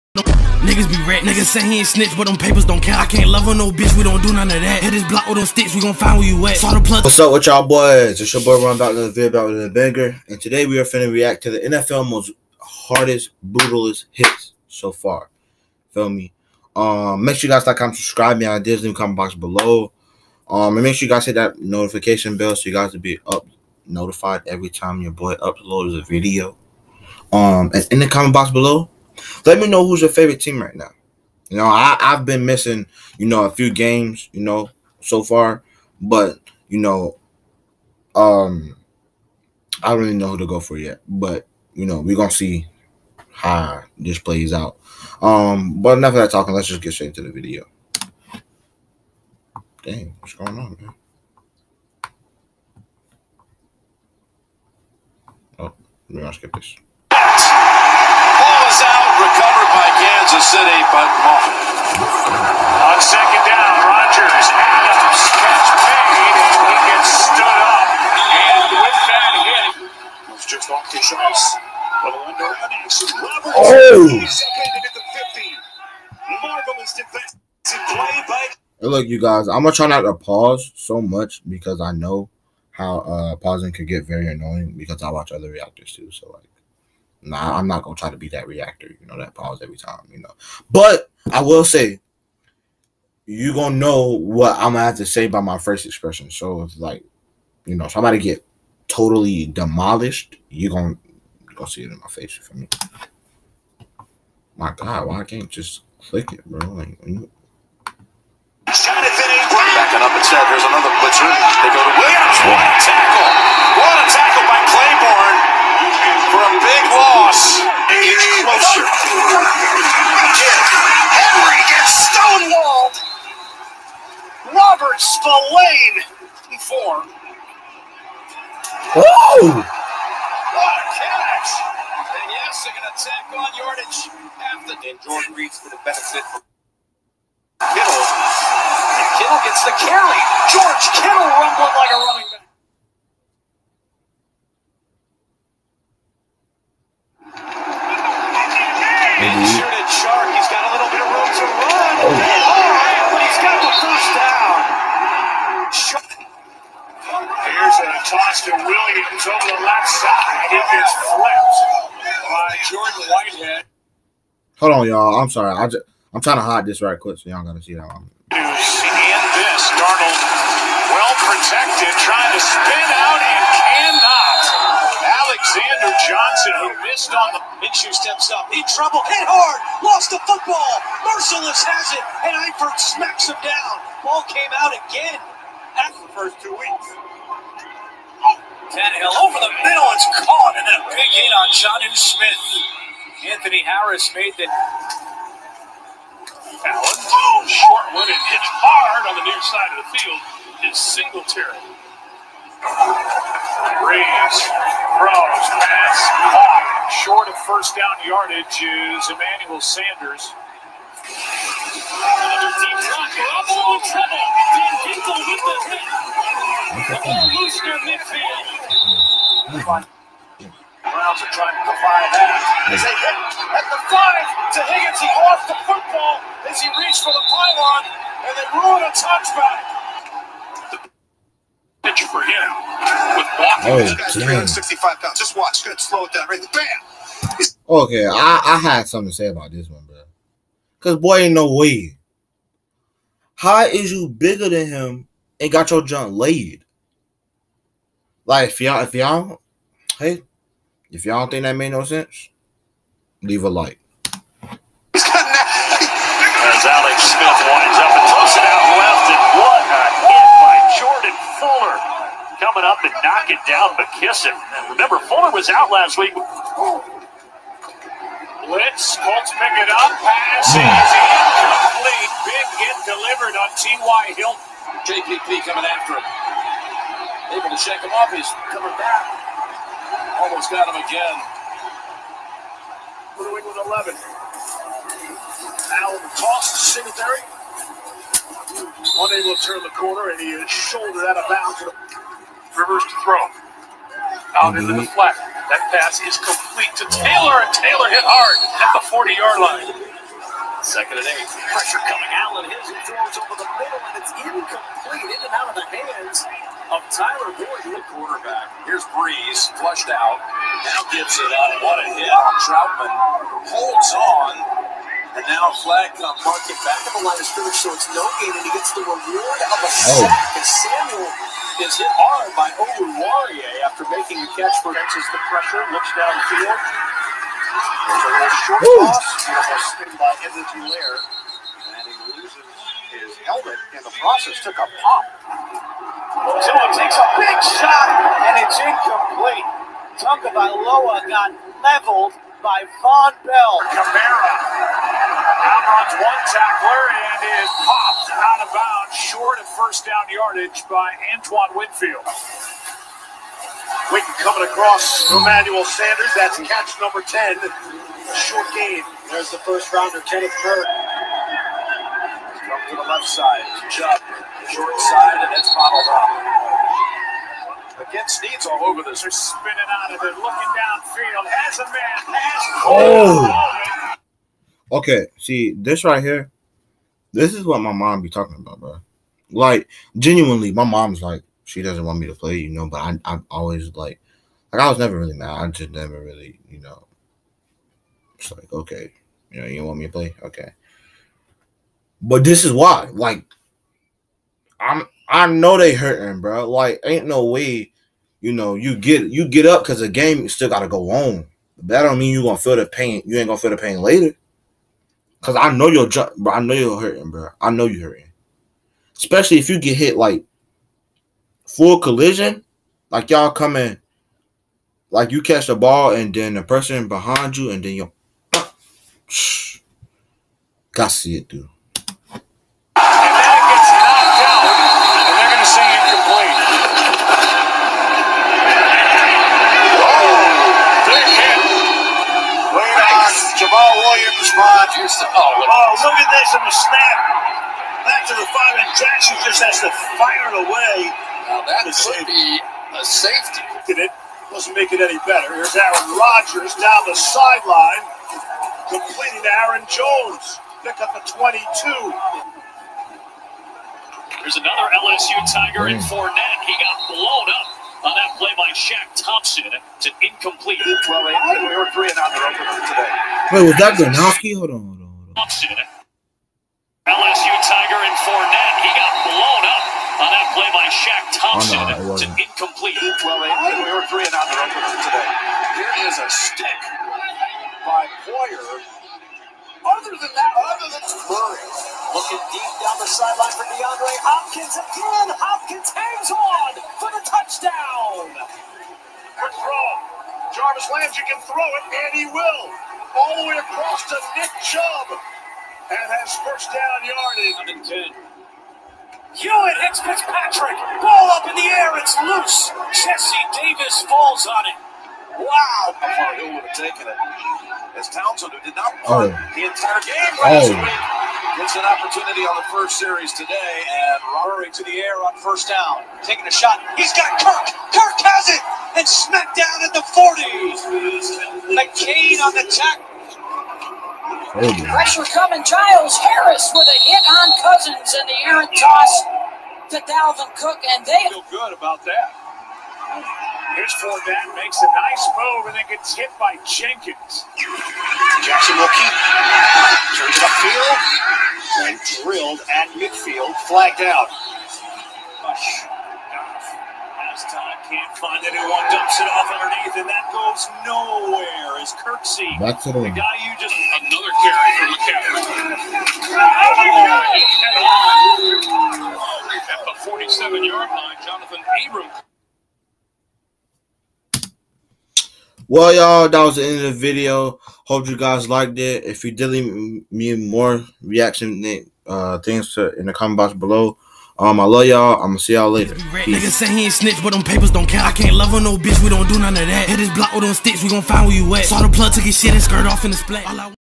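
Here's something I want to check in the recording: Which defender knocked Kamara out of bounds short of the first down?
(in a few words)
Antoine Winfield.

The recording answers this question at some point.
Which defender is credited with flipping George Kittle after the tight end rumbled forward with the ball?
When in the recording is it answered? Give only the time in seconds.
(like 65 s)
162 s.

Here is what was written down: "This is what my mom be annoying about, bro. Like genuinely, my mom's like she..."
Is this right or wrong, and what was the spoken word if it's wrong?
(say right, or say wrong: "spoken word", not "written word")
wrong: "talking", not "annoying".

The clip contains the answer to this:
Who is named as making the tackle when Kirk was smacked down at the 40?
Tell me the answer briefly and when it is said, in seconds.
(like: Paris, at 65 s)
McCain, at 521 s.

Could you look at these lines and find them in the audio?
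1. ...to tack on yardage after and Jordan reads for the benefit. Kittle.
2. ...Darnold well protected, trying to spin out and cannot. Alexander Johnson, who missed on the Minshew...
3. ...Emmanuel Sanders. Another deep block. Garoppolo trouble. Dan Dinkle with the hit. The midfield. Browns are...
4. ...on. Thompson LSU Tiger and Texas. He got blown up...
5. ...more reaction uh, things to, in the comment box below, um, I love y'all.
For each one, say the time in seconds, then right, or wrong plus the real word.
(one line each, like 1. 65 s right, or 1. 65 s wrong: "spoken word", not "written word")
1. 132 s right
2. 169 s right
3. 209 s right
4. 465 s wrong: "Fournette", not "Texas"
5. 570 s right.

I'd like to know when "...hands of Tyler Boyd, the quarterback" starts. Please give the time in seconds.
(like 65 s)
305 s.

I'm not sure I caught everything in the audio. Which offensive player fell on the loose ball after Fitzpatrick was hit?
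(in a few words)
Jesse Davis.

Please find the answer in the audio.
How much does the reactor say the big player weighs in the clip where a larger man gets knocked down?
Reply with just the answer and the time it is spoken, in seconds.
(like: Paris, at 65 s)
365 pounds, at 234 s.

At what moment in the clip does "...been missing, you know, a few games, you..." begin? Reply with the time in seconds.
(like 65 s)
32 s.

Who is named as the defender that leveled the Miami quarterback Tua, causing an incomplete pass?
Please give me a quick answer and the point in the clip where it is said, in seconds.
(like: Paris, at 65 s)
Vonn Bell, at 342 s.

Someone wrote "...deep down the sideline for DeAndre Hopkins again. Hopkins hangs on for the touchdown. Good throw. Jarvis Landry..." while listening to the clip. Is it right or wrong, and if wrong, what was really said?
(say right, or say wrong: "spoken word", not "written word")
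right.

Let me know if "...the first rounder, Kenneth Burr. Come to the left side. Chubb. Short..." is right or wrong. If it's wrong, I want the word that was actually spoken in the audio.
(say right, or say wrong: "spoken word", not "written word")
right.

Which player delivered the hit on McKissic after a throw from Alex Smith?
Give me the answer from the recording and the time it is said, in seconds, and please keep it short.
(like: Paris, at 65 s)
Jordan Fuller, at 260 s.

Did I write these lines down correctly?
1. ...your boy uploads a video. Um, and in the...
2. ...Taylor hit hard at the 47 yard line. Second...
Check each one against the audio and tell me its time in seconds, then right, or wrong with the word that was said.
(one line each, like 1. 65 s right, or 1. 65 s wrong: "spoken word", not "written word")
1. 25 s right
2. 297 s wrong: "40", not "47".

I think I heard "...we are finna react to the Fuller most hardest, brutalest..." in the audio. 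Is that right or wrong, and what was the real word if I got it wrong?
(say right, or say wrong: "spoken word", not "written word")
wrong: "NFL", not "Fuller".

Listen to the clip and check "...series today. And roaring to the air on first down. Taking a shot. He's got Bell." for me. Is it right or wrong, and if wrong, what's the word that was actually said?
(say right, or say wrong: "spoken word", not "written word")
wrong: "Kirk", not "Bell".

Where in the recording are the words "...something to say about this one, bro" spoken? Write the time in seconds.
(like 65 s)
238 s.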